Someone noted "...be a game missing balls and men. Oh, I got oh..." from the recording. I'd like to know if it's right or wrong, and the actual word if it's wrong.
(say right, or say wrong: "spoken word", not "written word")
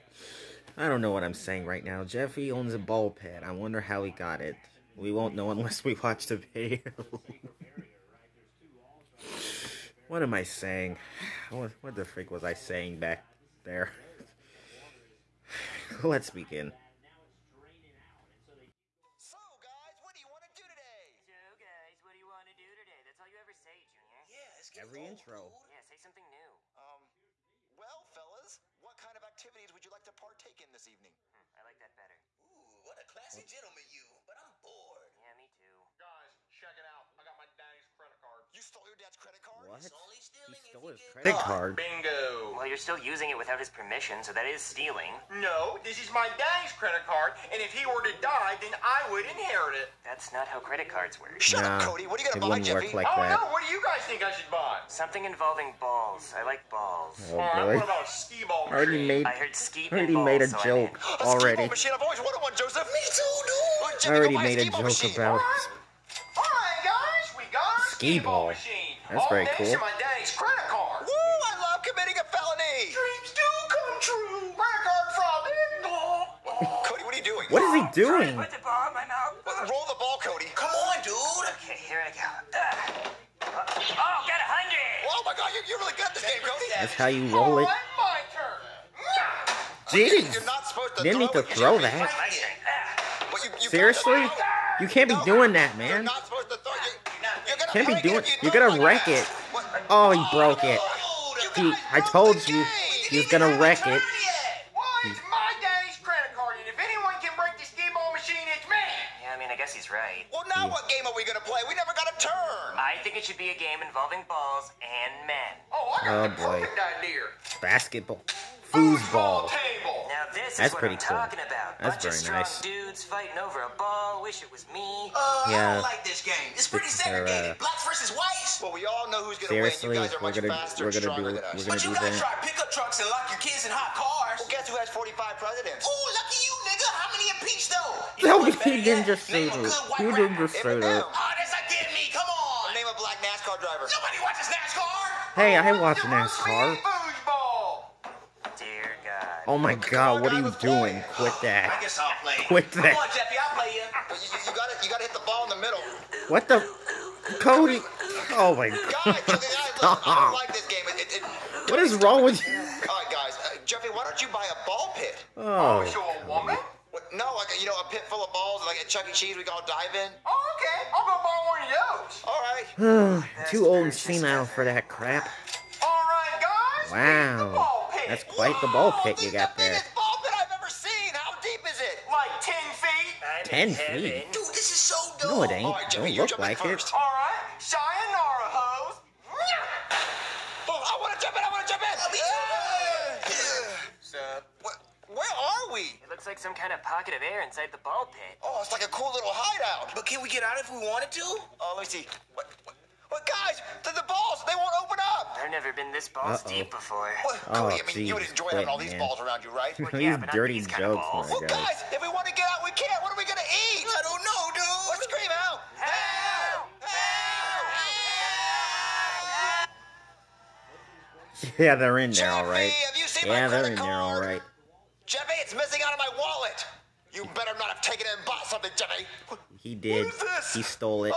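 wrong: "involving", not "missing".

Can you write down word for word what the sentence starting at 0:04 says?
We won't know unless we watch the video.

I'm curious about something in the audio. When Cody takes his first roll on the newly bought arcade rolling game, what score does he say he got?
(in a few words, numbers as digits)
100.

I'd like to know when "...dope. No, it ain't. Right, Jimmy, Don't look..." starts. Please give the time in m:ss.
3:05.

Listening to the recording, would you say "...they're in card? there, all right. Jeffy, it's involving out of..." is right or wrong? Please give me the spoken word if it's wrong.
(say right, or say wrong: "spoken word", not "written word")
wrong: "missing", not "involving".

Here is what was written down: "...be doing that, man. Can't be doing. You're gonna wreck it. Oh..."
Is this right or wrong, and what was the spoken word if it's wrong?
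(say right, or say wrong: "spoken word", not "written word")
right.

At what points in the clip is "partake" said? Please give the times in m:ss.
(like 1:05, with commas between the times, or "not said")
0:30.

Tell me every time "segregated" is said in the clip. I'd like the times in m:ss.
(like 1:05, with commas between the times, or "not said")
2:06.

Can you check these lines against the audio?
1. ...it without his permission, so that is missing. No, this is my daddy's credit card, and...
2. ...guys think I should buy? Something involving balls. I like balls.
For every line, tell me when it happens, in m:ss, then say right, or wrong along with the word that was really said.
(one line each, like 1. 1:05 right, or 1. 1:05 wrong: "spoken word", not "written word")
1. 0:43 wrong: "stealing", not "missing"
2. 0:53 right.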